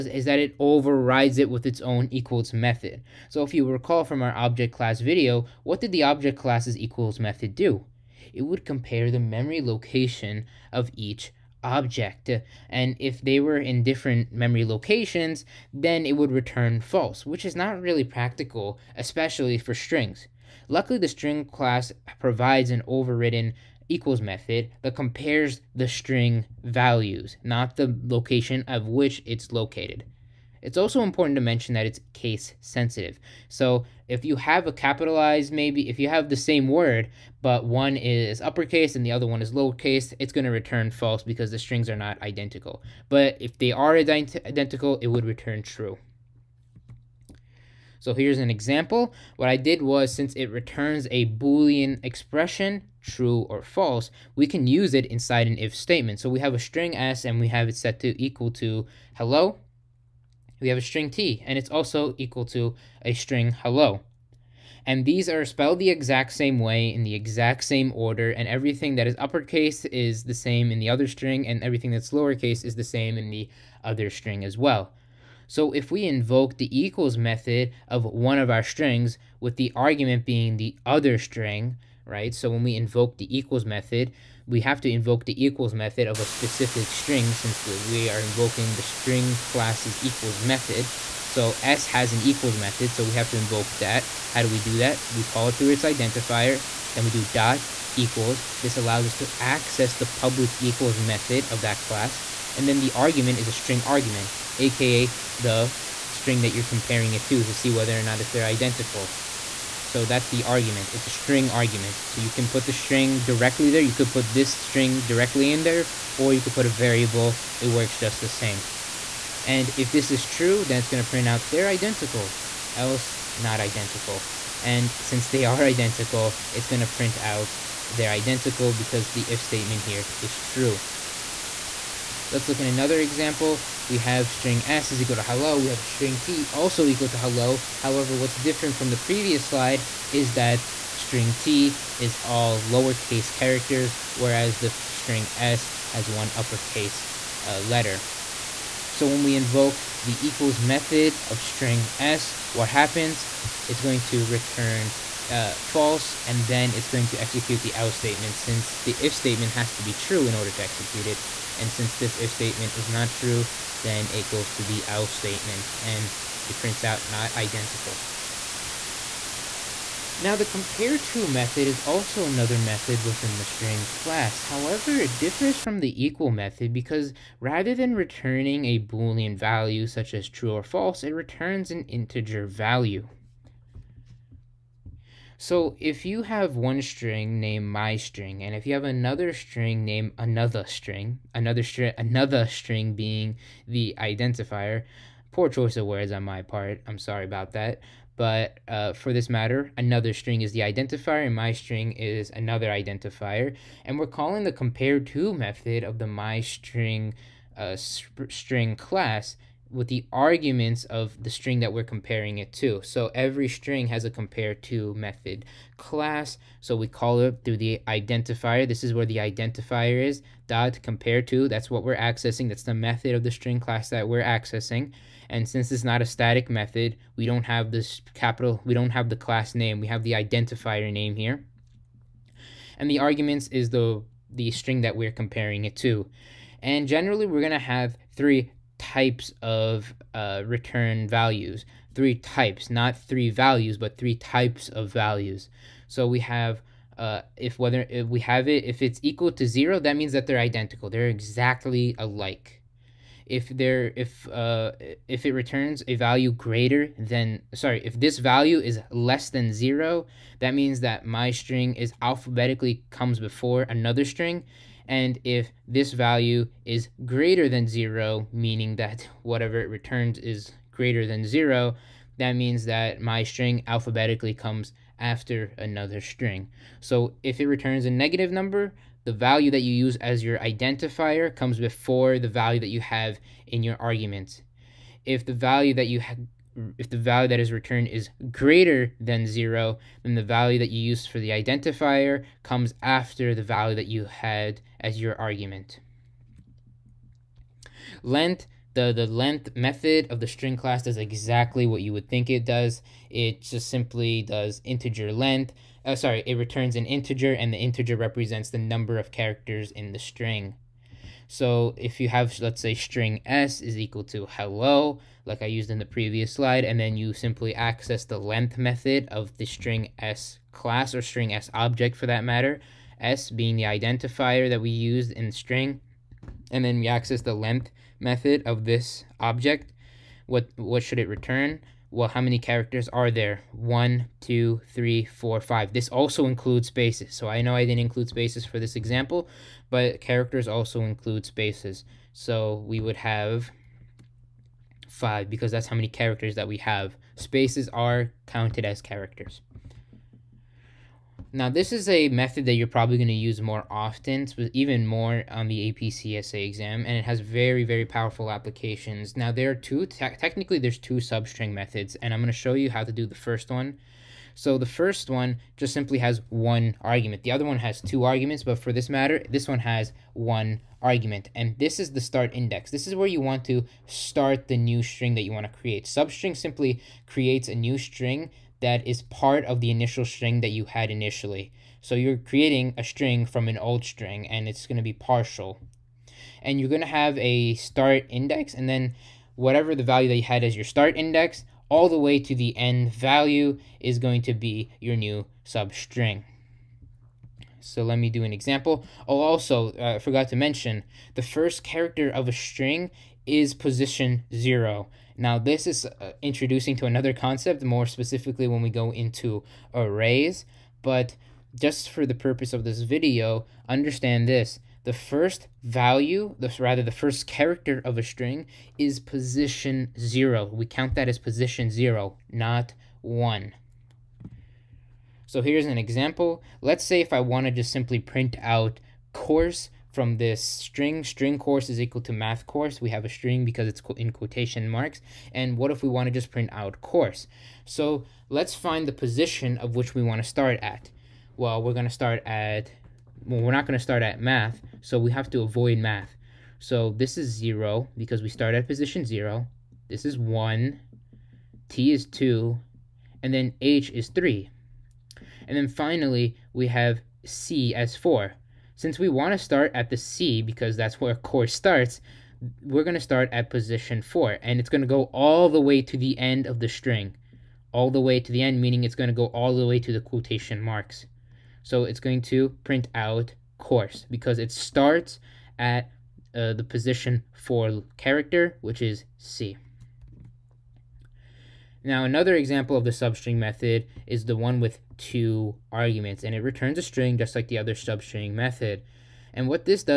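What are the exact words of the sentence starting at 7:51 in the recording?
So it's going to print out course because it starts at uh, the position for character, which is C.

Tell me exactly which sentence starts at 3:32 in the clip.
So every string has a compare to method class.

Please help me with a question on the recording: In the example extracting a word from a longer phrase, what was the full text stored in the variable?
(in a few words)
math course.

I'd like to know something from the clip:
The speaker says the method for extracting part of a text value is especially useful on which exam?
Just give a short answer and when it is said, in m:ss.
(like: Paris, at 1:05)
AP CSA exam, at 5:55.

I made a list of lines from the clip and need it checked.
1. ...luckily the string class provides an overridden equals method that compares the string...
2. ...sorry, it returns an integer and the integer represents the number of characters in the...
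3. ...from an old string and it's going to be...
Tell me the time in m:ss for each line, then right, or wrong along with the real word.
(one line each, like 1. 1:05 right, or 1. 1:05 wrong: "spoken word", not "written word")
1. 0:20 right
2. 5:05 right
3. 6:23 right.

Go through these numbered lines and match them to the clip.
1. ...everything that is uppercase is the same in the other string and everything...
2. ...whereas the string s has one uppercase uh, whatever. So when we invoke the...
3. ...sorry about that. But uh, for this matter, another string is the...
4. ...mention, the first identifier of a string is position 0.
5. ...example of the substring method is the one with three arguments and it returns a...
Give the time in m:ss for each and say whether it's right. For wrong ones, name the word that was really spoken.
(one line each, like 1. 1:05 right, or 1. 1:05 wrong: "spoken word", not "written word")
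1. 1:08 right
2. 2:24 wrong: "letter", not "whatever"
3. 3:16 right
4. 6:40 wrong: "character", not "identifier"
5. 8:02 wrong: "two", not "three".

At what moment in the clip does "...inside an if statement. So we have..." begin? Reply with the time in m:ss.
0:55.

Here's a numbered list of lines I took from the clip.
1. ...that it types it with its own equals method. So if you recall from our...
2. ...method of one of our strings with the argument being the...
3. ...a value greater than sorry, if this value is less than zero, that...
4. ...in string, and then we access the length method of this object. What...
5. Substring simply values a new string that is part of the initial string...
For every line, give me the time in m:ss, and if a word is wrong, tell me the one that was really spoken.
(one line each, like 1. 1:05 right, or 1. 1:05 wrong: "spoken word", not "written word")
1. 0:00 wrong: "overrides", not "types"
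2. 1:17 right
3. 4:15 right
4. 5:25 right
5. 6:15 wrong: "creates", not "values".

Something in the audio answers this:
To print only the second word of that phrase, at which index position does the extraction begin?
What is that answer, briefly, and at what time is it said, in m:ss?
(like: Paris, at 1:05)
4, at 7:43.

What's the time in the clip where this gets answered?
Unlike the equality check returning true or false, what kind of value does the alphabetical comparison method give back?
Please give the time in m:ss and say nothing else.
3:01.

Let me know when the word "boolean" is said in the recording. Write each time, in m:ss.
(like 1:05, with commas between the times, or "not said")
0:51, 2:58.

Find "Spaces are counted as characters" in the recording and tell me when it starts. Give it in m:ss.
5:47.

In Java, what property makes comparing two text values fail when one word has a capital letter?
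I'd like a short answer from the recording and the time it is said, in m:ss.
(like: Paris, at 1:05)
case sensitive, at 0:32.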